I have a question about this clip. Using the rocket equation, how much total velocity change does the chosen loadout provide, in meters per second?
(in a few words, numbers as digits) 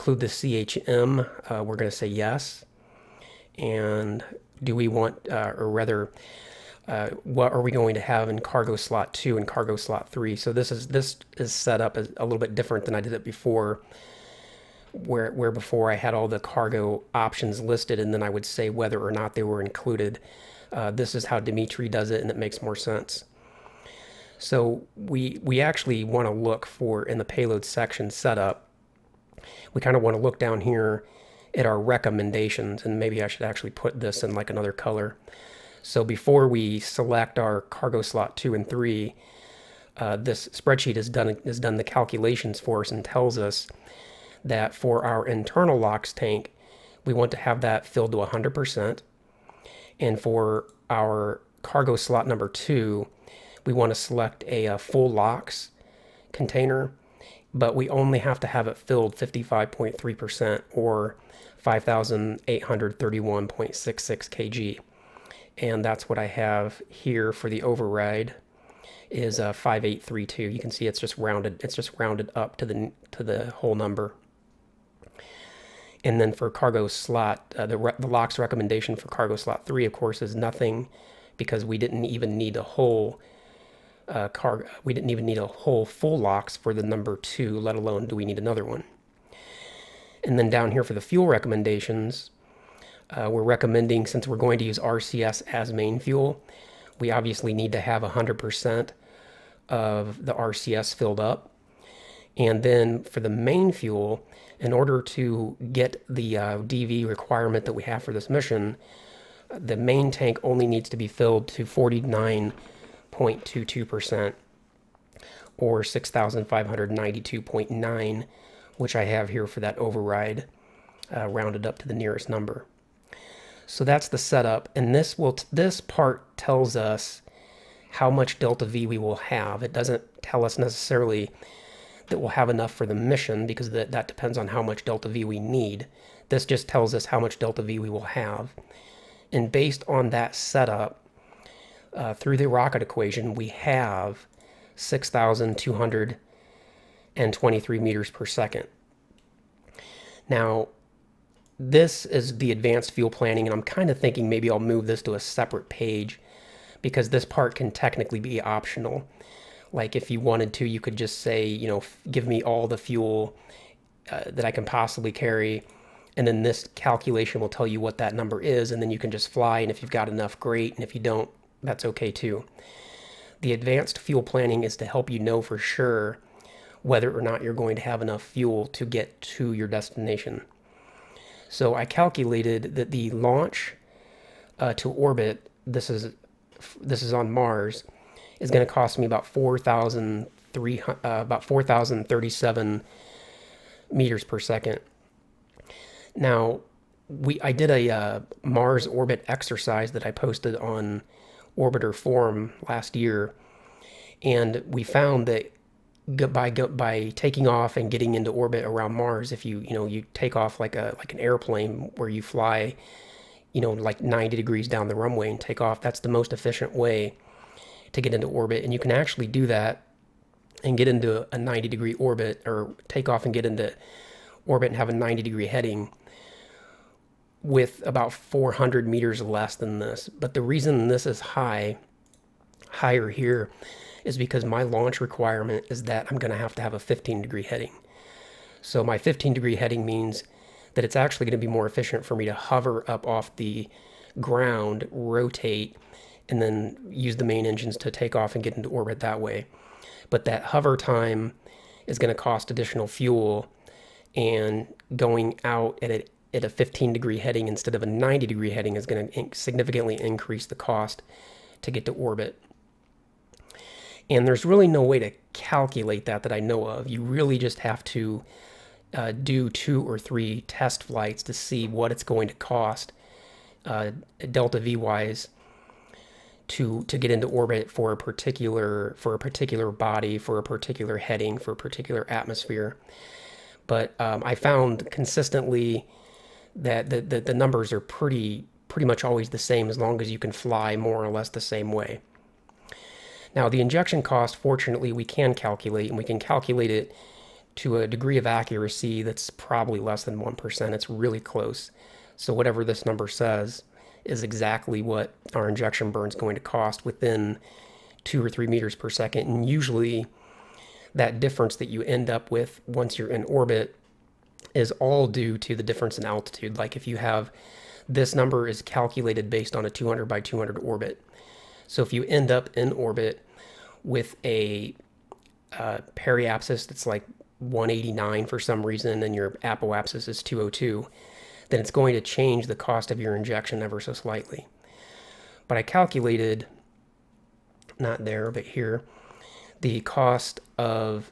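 6,223.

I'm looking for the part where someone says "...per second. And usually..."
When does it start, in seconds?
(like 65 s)
308 s.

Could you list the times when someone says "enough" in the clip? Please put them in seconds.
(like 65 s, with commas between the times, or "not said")
132 s, 170 s, 177 s.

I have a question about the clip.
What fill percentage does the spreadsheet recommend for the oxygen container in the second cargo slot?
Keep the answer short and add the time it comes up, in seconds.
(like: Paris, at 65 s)
55.3%, at 59 s.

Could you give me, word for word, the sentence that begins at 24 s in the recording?
So we we actually want to look for in the payload section setup.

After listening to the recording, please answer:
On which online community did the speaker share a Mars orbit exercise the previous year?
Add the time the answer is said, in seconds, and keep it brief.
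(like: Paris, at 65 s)
Orbiter Forum, at 201 s.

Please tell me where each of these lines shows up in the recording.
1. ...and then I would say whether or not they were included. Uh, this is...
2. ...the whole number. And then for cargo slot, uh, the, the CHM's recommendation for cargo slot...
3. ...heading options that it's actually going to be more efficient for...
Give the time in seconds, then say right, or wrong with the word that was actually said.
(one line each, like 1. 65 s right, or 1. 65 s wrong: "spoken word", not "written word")
1. 17 s right
2. 73 s wrong: "LOX", not "CHM"
3. 239 s wrong: "means", not "options".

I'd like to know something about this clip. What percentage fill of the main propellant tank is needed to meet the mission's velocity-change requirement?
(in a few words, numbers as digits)
49.22%.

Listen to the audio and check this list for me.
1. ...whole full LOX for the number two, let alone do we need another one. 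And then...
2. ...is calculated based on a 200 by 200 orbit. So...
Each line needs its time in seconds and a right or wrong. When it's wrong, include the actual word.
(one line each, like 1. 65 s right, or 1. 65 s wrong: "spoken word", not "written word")
1. 85 s right
2. 318 s right.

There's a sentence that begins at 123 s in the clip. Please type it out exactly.
So that's the setup, and this will this part tells us how much delta V we will have.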